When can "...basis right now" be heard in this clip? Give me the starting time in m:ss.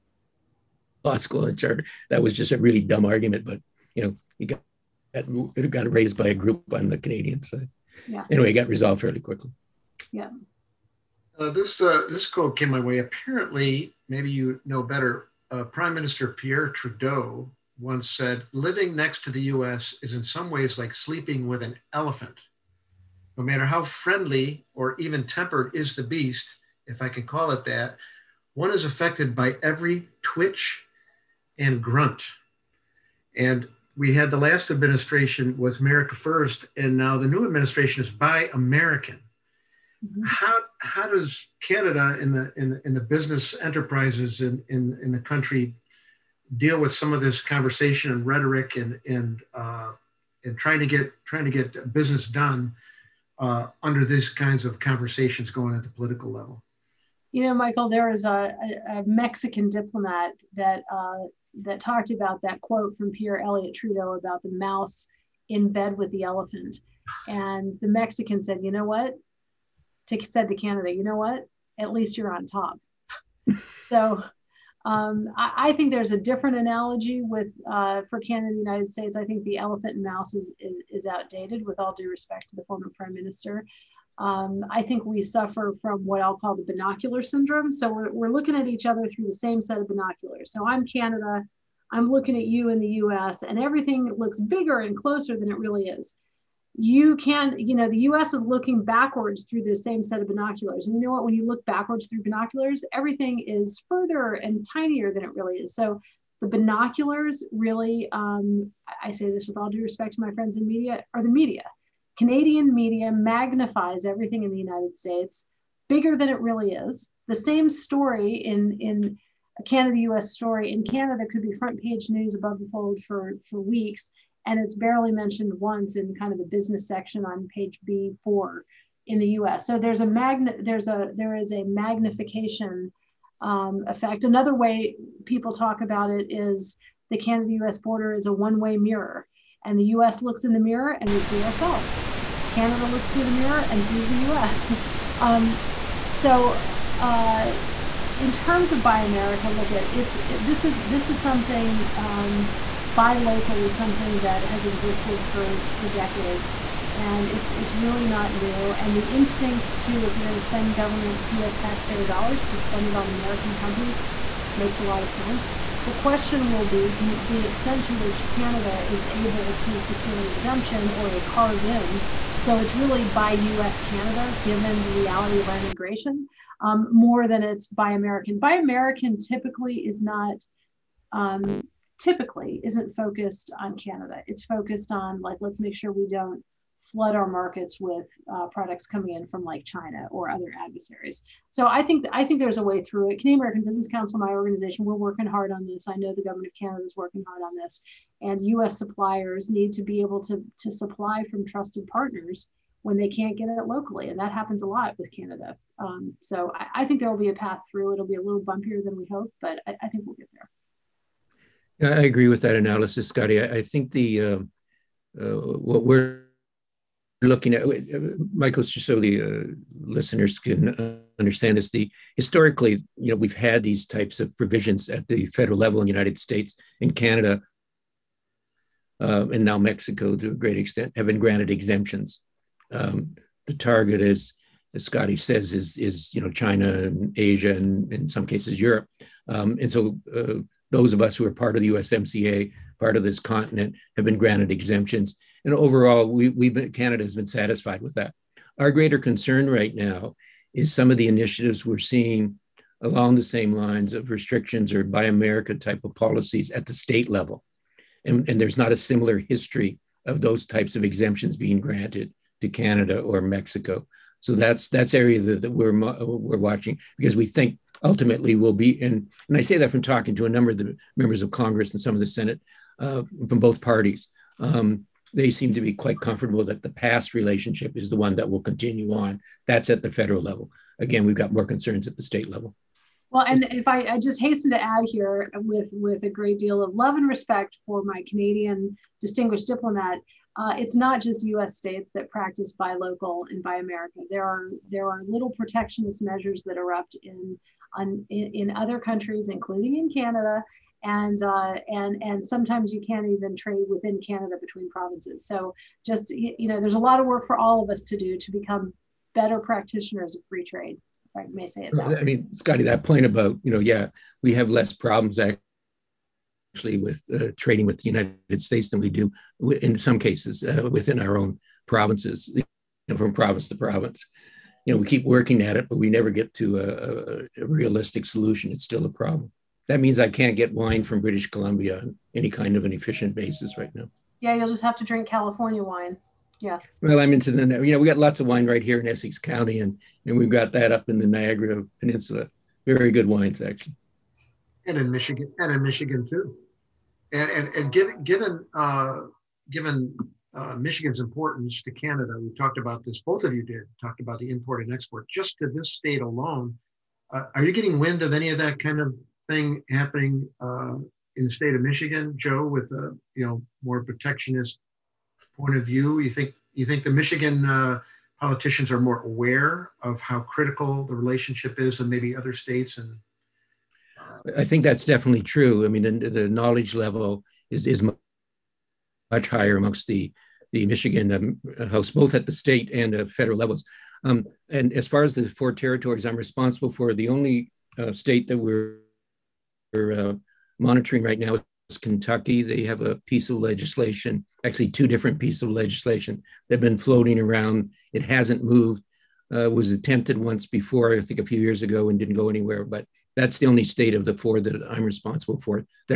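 5:33.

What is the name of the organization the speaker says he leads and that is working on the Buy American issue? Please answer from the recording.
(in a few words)
Canadian American Business Council.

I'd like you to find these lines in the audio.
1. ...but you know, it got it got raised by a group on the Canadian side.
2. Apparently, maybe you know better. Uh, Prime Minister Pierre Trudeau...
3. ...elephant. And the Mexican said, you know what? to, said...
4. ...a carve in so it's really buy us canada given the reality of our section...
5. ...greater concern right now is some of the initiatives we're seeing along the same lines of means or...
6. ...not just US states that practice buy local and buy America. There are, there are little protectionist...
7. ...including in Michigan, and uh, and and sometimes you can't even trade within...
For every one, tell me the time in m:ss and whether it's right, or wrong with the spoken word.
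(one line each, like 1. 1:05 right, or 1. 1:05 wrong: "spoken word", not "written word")
1. 0:03 right
2. 0:12 right
3. 1:06 right
4. 2:51 wrong: "integration", not "section"
5. 4:08 wrong: "restrictions", not "means"
6. 4:50 right
7. 4:59 wrong: "Canada", not "Michigan".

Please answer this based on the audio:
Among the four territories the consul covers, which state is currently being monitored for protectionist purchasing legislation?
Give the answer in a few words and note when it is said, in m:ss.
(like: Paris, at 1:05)
Kentucky, at 6:31.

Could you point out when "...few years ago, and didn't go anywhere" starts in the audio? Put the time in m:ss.
6:41.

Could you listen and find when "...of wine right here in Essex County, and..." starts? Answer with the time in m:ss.
5:38.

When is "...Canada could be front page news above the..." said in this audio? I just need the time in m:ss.
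2:00.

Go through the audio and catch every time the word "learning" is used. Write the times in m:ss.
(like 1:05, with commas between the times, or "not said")
not said.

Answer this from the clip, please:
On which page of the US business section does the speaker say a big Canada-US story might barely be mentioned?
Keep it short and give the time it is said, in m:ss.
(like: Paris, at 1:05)
B4, at 2:07.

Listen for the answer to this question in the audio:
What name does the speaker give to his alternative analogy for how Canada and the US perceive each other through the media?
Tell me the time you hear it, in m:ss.
1:26.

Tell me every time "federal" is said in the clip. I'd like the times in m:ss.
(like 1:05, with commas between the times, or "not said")
3:45, 4:39, 6:23.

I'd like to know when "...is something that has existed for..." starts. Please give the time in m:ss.
2:33.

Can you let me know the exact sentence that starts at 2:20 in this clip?
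looks in the mirror and we see ourselves.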